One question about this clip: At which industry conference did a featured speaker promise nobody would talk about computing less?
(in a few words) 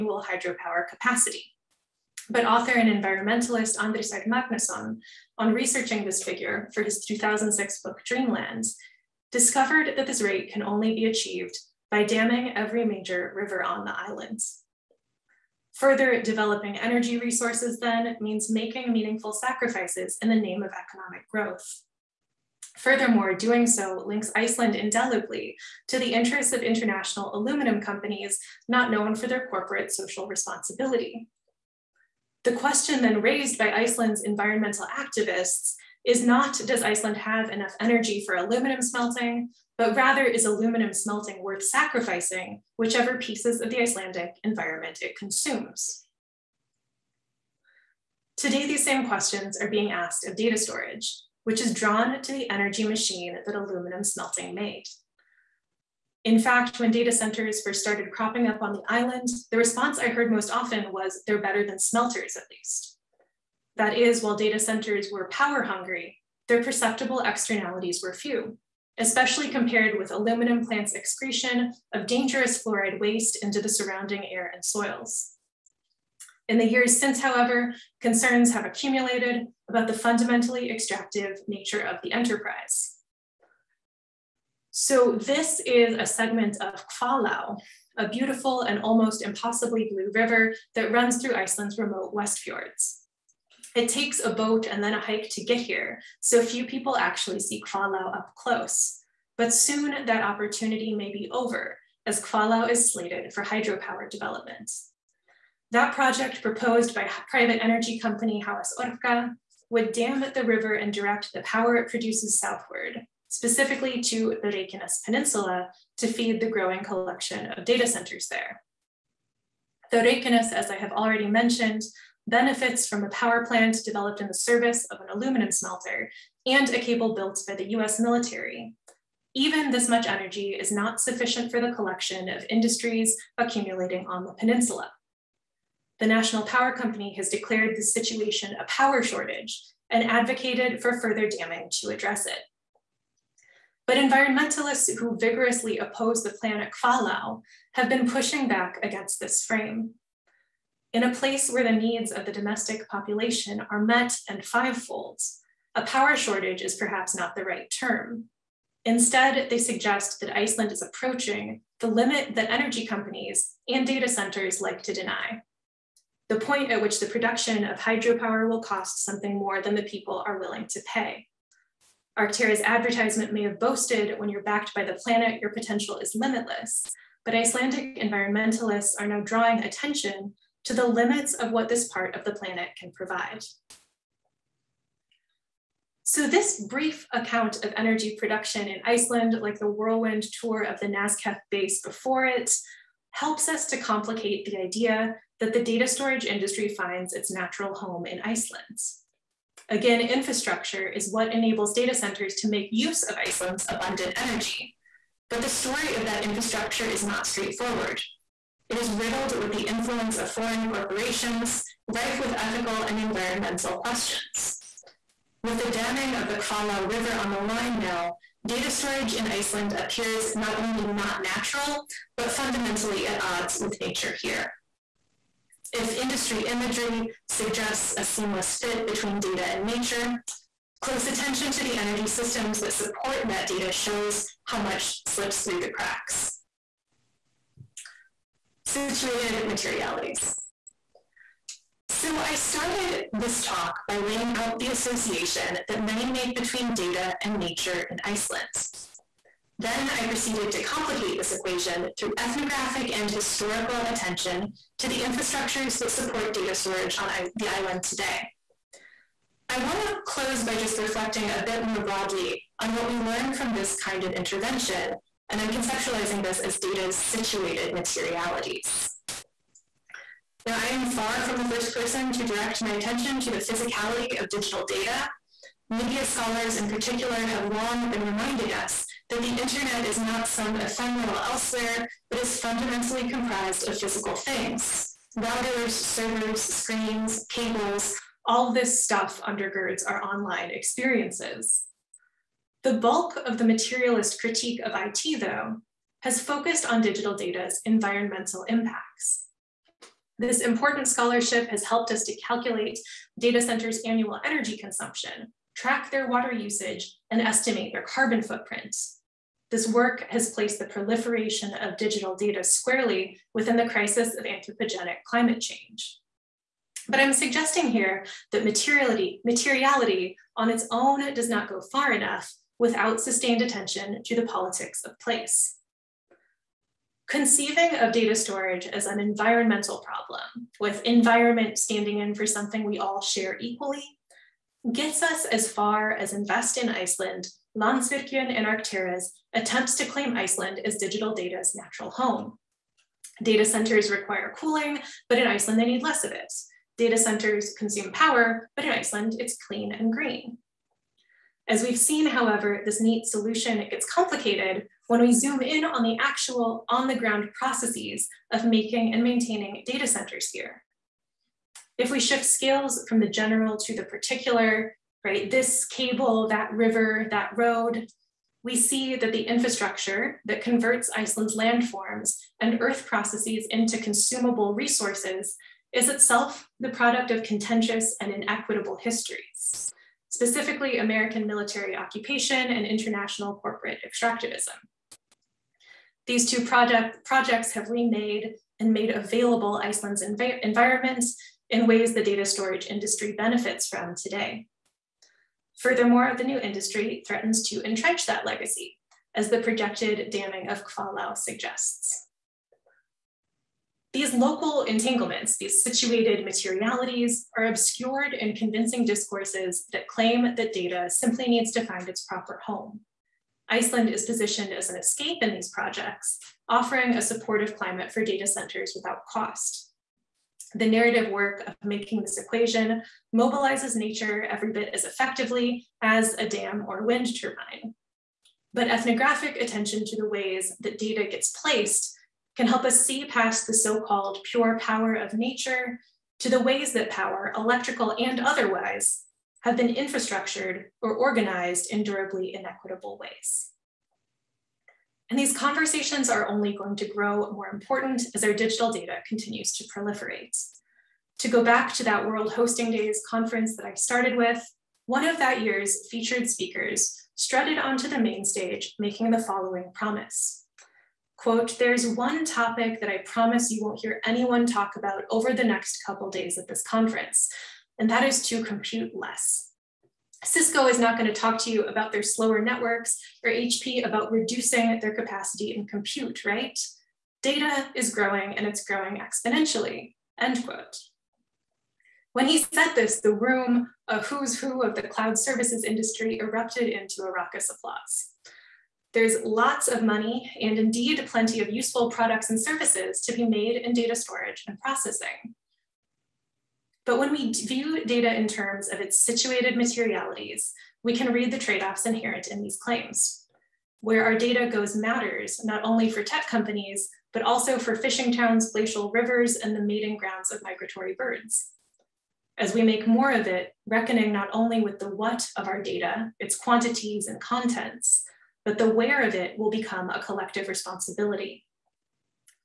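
World Hosting Days.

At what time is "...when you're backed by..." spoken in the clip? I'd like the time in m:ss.
2:54.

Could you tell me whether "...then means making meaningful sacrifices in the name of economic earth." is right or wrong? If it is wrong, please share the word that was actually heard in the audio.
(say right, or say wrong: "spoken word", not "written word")
wrong: "growth", not "earth".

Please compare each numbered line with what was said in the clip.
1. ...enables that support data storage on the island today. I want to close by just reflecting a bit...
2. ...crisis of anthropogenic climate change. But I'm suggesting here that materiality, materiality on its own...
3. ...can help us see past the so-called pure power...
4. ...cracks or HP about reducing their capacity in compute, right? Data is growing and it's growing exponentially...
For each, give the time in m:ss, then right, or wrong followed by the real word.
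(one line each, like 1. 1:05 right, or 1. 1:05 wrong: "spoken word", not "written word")
1. 4:15 wrong: "infrastructures", not "enables"
2. 5:13 right
3. 7:12 right
4. 7:52 wrong: "networks", not "cracks".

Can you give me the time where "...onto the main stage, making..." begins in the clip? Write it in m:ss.
7:37.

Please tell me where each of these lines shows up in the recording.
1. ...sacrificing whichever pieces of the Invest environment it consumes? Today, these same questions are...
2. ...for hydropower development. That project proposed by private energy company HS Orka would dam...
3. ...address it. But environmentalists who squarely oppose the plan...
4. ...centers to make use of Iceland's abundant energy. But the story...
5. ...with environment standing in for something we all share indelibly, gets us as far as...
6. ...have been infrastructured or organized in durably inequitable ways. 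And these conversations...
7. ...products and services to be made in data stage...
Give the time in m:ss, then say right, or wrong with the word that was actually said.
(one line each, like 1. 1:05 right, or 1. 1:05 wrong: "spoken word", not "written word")
1. 0:41 wrong: "Icelandic", not "Invest"
2. 1:43 right
3. 2:21 wrong: "vigorously", not "squarely"
4. 3:21 right
5. 5:30 wrong: "equally", not "indelibly"
6. 7:19 right
7. 8:11 wrong: "storage", not "stage".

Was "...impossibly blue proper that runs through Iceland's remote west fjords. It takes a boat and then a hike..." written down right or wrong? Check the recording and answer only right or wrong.
wrong.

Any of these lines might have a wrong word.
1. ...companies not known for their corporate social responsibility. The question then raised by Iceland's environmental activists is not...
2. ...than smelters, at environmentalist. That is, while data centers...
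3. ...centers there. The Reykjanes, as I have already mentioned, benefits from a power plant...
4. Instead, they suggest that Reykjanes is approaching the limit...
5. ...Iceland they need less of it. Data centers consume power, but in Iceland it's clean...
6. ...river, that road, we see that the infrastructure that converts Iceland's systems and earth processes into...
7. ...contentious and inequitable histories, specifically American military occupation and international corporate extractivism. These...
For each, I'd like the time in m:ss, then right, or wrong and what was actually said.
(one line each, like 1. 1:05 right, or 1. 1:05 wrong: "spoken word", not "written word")
1. 0:27 right
2. 1:01 wrong: "least", not "environmentalist"
3. 1:57 right
4. 2:38 wrong: "Iceland", not "Reykjanes"
5. 5:45 right
6. 6:06 wrong: "landforms", not "systems"
7. 6:17 right.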